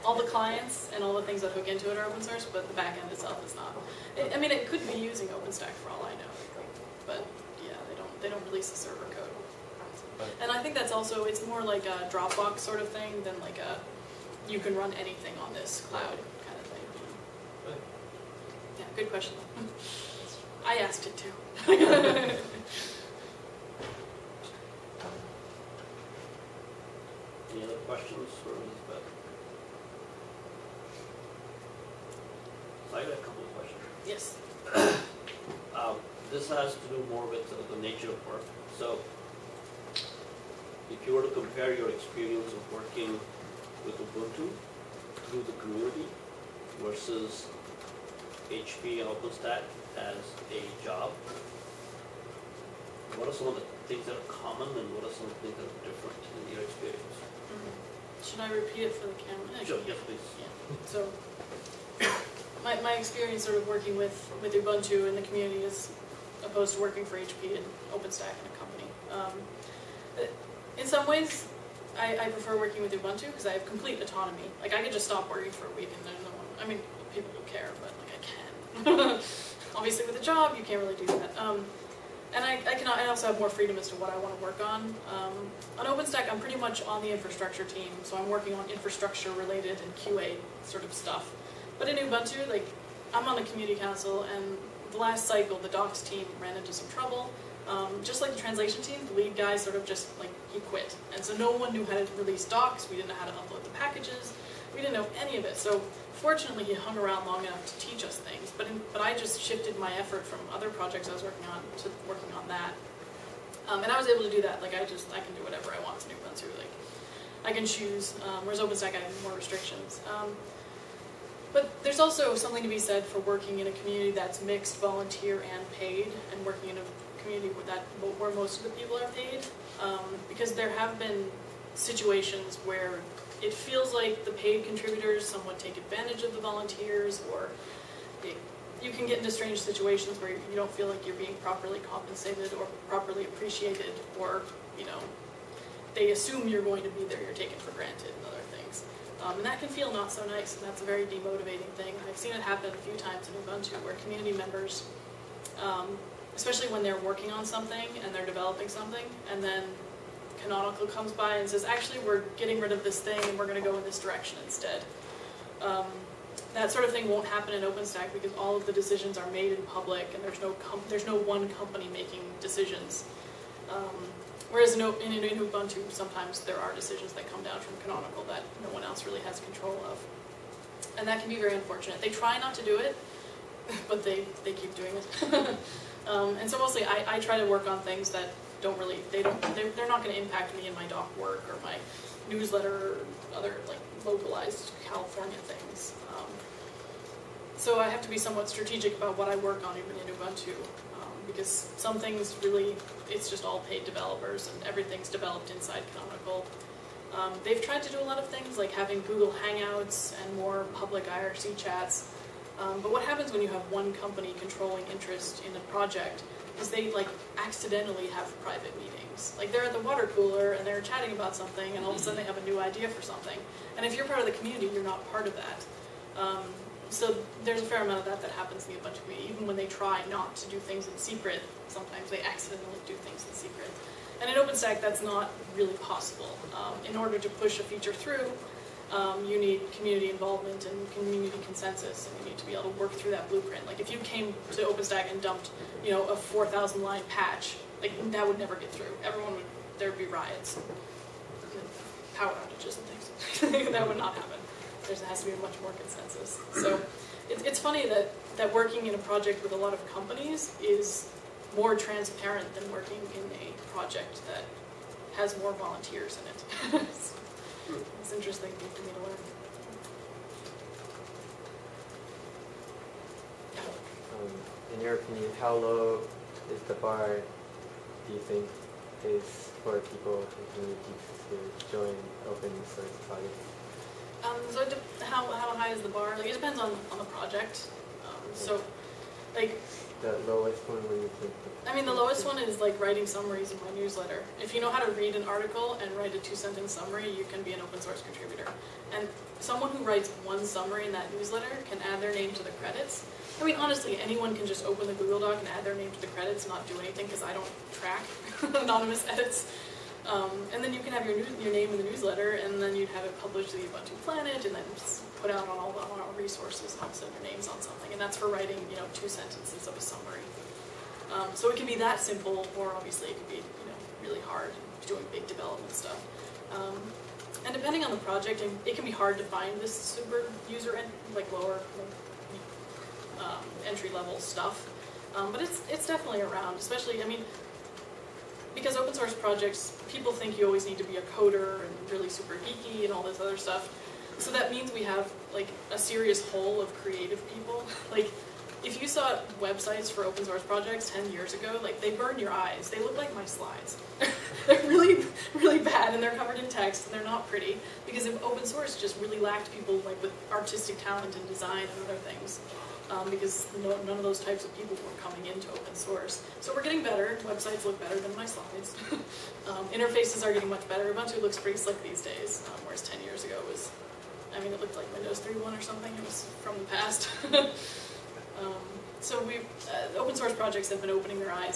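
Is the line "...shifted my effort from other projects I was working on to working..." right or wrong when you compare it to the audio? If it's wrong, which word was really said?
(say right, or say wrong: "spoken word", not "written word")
right.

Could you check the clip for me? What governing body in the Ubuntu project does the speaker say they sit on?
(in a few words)
community council.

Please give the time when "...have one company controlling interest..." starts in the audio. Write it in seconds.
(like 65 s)
213 s.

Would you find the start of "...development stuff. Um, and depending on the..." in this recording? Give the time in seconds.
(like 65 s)
325 s.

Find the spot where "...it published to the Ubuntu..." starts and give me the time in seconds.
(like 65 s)
313 s.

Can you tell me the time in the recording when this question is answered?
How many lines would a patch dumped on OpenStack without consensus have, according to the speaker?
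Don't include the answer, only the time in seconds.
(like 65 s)
246 s.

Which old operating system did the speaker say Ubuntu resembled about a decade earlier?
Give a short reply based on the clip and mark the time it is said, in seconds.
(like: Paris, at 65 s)
Windows 3.1, at 374 s.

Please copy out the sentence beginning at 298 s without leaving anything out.
And someone who writes one summary in that newsletter can add their name to the credits.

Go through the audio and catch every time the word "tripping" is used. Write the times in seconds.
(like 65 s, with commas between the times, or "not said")
not said.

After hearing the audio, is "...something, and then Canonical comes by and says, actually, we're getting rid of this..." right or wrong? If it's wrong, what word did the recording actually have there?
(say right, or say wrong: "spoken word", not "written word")
right.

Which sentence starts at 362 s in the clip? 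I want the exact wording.
Um, because no, none of those types of people were coming into open source.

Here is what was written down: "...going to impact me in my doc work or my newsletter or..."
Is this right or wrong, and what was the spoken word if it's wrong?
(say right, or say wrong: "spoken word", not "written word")
right.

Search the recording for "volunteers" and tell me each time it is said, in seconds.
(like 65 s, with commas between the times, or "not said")
124 s, 136 s, 265 s.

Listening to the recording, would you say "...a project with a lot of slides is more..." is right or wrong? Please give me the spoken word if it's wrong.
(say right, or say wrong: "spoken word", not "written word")
wrong: "companies", not "slides".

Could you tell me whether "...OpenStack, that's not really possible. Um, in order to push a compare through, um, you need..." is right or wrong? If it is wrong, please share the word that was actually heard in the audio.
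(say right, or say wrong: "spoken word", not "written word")
wrong: "feature", not "compare".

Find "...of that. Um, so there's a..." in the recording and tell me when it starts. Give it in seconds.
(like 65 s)
225 s.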